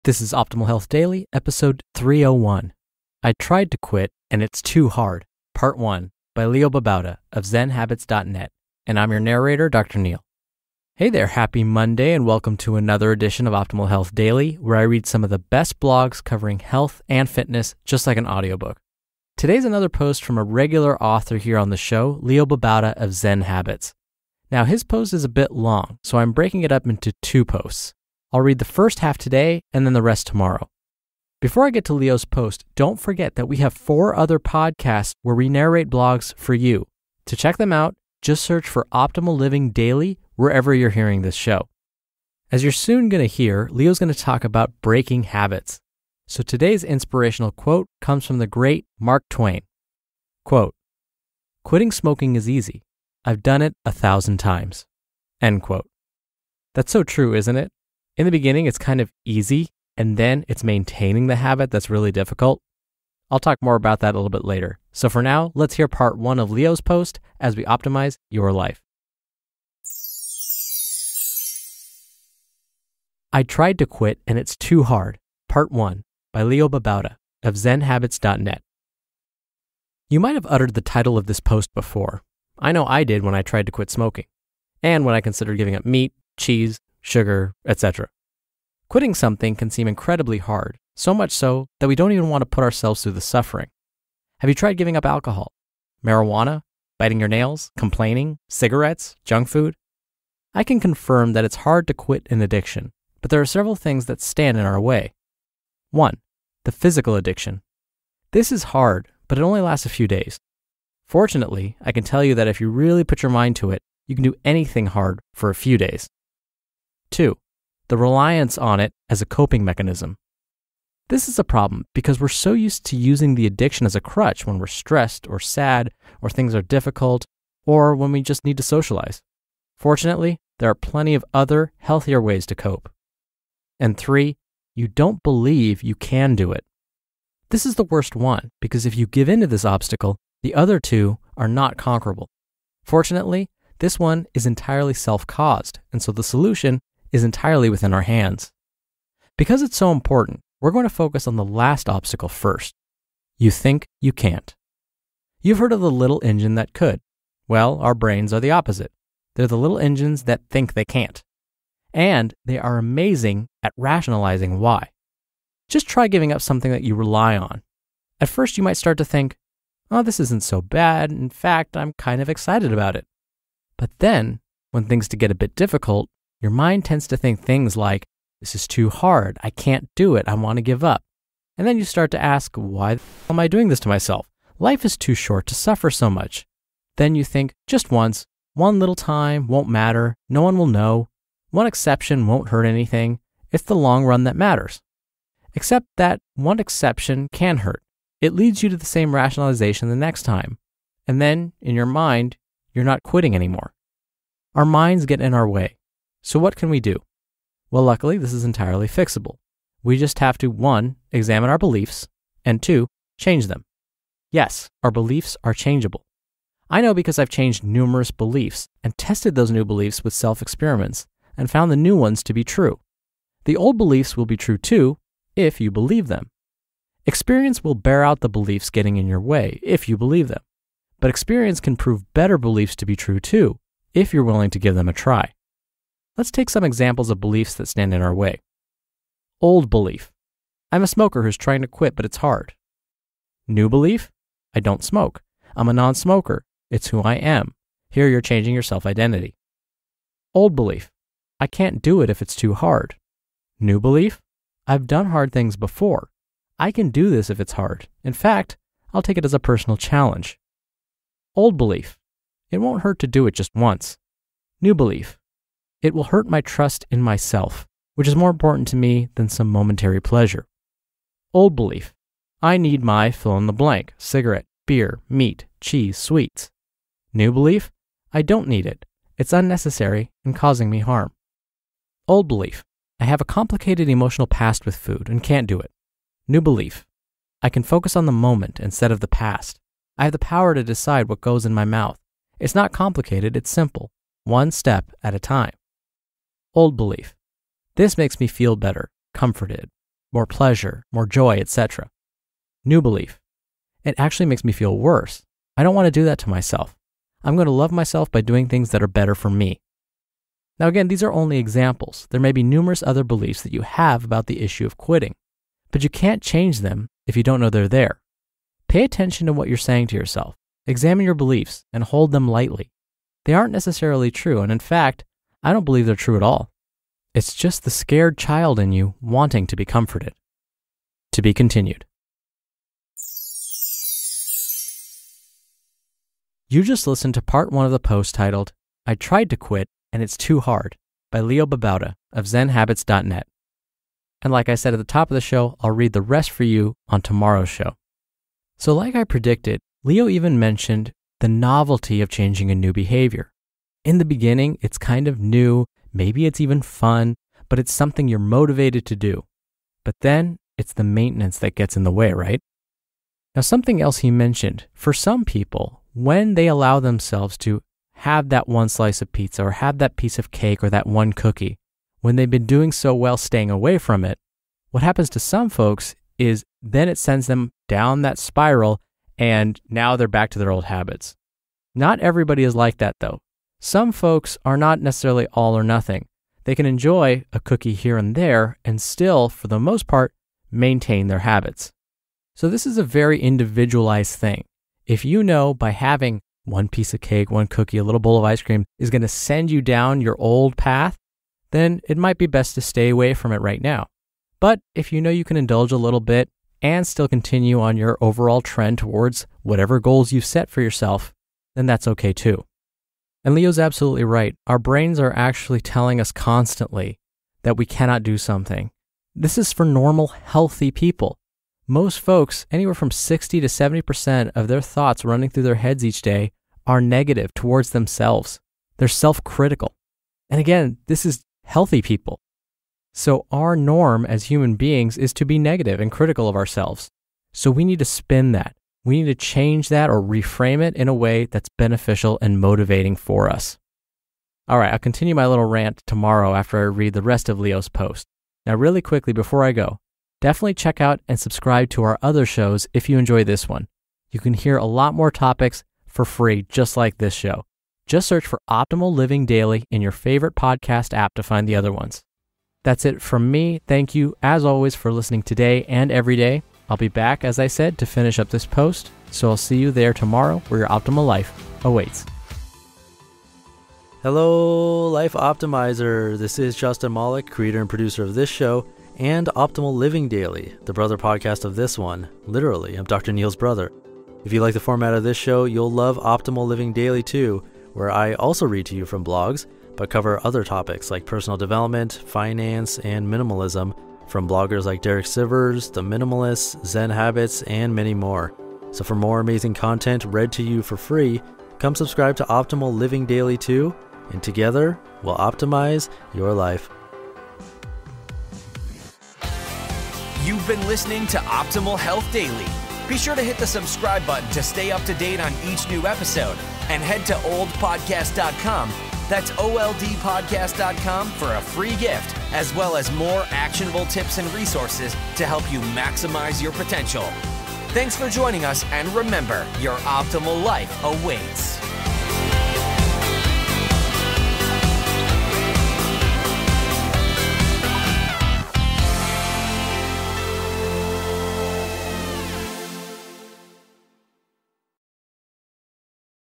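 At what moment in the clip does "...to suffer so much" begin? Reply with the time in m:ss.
3:05.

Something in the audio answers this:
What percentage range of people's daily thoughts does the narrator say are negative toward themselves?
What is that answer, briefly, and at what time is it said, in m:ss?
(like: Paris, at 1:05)
60 to 70%, at 7:02.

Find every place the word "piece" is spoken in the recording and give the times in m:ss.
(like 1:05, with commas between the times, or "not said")
6:09, 6:36.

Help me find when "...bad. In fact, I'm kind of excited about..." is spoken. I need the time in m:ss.
2:50.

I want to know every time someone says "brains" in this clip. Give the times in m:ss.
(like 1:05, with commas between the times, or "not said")
2:37, 6:54.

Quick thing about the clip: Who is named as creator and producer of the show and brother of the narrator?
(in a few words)
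Justin Malik.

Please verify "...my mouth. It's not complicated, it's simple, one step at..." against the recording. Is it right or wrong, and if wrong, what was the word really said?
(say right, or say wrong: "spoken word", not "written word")
right.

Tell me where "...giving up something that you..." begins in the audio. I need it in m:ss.
2:46.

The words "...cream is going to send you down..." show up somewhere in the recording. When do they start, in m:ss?
6:38.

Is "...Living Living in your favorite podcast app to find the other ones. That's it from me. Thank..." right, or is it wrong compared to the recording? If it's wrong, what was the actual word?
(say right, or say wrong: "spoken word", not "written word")
wrong: "Daily", not "Living".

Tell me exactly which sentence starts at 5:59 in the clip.
But then it's the maintenance that gets in the way, right?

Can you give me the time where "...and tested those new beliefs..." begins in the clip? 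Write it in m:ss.
3:38.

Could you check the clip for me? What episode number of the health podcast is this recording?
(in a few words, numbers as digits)
301.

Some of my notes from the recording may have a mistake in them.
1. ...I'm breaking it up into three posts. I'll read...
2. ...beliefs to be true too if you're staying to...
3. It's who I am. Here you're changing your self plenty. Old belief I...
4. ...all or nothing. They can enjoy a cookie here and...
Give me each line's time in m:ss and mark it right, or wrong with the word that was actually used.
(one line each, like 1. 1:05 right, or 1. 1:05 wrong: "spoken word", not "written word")
1. 0:26 wrong: "two", not "three"
2. 3:52 wrong: "willing", not "staying"
3. 4:06 wrong: "identity", not "plenty"
4. 6:25 right.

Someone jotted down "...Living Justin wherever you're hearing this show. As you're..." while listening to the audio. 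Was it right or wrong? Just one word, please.
wrong.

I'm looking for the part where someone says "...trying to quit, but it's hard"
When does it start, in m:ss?
4:01.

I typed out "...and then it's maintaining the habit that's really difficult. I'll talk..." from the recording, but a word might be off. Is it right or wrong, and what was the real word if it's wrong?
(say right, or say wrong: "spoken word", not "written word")
right.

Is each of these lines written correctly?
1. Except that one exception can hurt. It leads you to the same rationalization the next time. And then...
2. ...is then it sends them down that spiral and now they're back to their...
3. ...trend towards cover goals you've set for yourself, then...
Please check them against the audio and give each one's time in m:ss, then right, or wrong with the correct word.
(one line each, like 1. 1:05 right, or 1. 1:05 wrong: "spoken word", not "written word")
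1. 3:15 right
2. 6:16 right
3. 6:48 wrong: "whatever", not "cover".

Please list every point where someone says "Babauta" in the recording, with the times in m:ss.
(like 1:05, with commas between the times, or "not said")
0:06, 0:22, 1:16, 5:41.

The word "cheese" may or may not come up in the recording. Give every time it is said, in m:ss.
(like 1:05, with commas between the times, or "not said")
1:26, 4:35.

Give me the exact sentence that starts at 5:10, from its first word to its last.
Now, again, these are only examples.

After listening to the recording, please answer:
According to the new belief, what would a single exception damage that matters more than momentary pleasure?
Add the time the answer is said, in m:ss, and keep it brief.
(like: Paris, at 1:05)
Trust in myself, at 4:26.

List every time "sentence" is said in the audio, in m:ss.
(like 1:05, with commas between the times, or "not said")
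not said.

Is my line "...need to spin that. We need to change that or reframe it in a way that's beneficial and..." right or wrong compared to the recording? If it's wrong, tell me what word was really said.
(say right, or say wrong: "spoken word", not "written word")
right.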